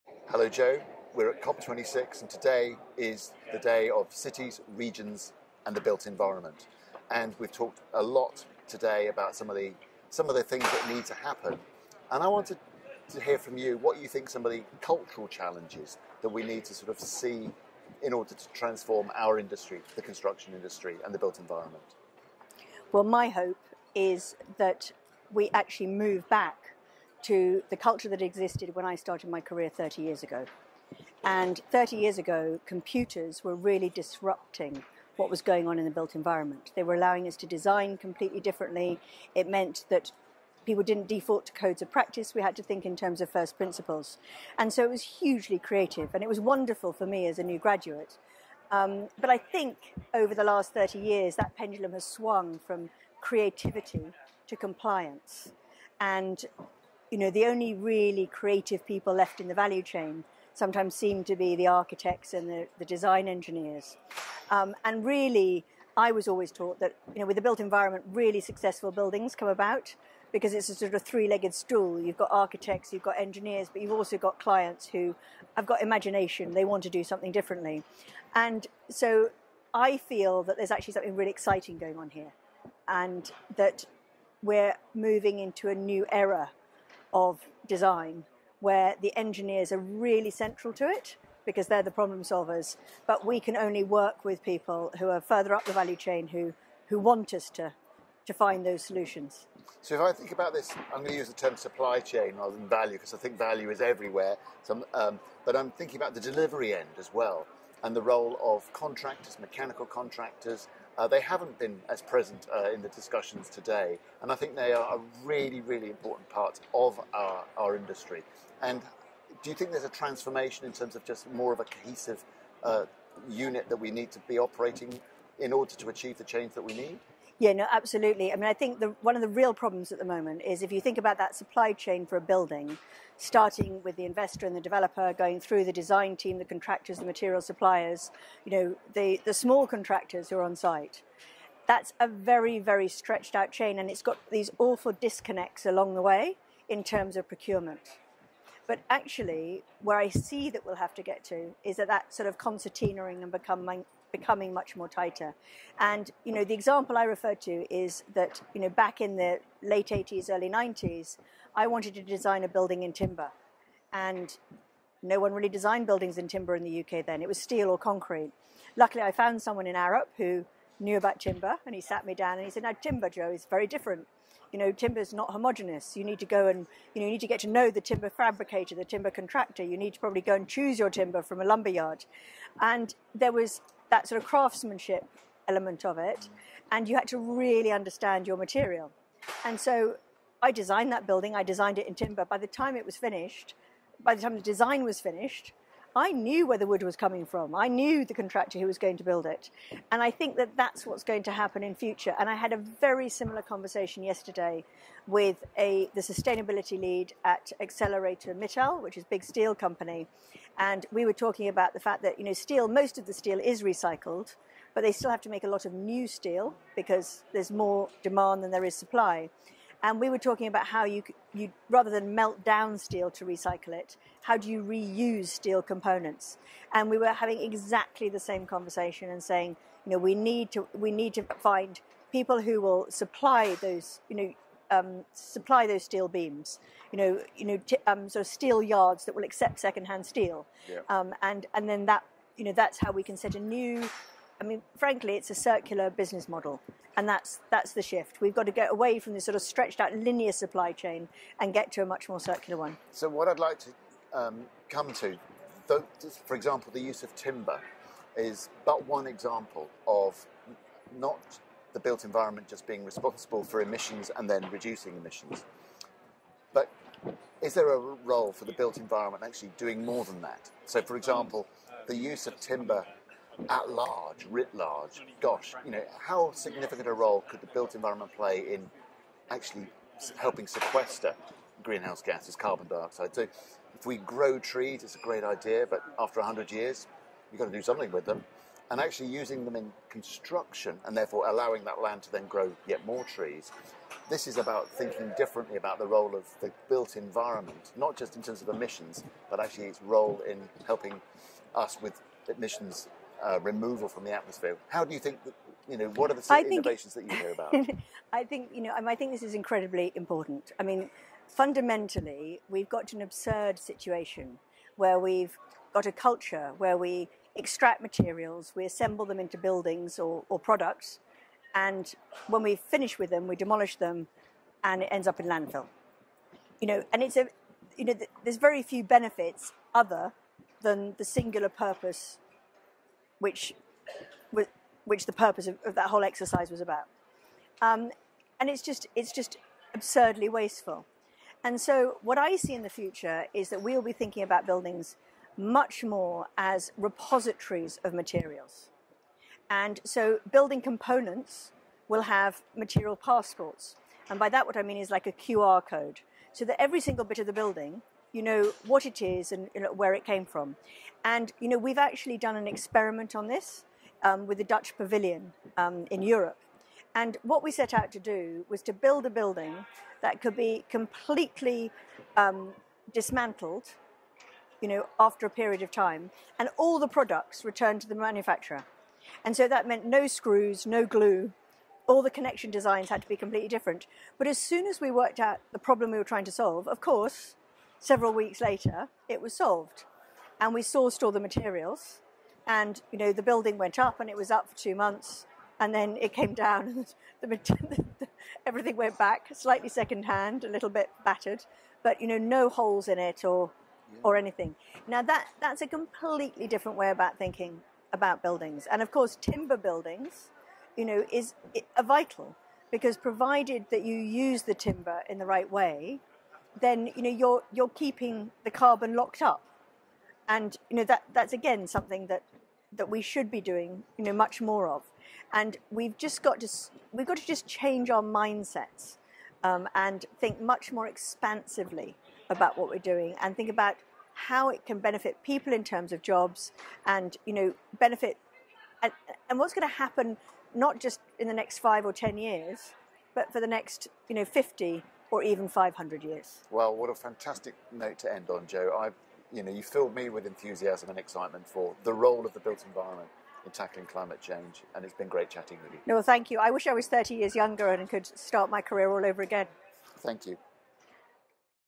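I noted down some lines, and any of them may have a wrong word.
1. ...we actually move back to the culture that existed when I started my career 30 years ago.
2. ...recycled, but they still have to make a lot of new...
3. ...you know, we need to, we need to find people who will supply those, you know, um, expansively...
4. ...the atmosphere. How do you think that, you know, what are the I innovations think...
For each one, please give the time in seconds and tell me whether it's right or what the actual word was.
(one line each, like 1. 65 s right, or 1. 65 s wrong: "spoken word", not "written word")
1. 25 s right
2. 213 s right
3. 229 s wrong: "supply", not "expansively"
4. 304 s right.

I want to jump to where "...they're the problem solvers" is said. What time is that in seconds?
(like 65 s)
91 s.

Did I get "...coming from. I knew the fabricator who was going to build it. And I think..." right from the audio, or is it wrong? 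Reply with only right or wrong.
wrong.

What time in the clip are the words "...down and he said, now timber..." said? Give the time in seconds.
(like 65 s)
172 s.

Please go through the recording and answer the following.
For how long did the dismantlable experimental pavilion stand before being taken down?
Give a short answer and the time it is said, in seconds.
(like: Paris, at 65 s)
2 months, at 394 s.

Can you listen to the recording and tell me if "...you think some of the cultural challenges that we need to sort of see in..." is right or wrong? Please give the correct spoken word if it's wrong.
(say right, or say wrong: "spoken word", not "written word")
right.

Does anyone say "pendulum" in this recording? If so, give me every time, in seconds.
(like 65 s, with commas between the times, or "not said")
51 s.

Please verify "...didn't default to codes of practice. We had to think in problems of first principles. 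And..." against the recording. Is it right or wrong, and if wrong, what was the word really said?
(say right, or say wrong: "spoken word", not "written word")
wrong: "terms", not "problems".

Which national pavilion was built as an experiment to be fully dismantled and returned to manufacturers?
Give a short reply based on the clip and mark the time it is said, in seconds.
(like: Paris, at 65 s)
Dutch Pavilion, at 364 s.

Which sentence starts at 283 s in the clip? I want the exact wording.
So if we grow trees, it's a great idea, but after 100 years, you've got to do something with them.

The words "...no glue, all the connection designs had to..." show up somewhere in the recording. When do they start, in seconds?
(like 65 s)
380 s.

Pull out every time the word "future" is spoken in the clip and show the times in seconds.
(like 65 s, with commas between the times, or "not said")
201 s, 342 s.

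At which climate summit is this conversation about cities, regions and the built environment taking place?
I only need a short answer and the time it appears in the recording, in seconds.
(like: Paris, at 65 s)
COP26, at 1 s.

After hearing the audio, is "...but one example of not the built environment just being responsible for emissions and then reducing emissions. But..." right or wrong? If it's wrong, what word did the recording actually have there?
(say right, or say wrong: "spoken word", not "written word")
right.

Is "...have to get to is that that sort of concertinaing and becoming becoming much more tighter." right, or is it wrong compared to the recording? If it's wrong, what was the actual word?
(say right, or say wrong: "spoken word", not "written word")
right.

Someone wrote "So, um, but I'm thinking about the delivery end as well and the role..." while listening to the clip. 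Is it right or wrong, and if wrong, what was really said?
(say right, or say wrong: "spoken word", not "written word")
right.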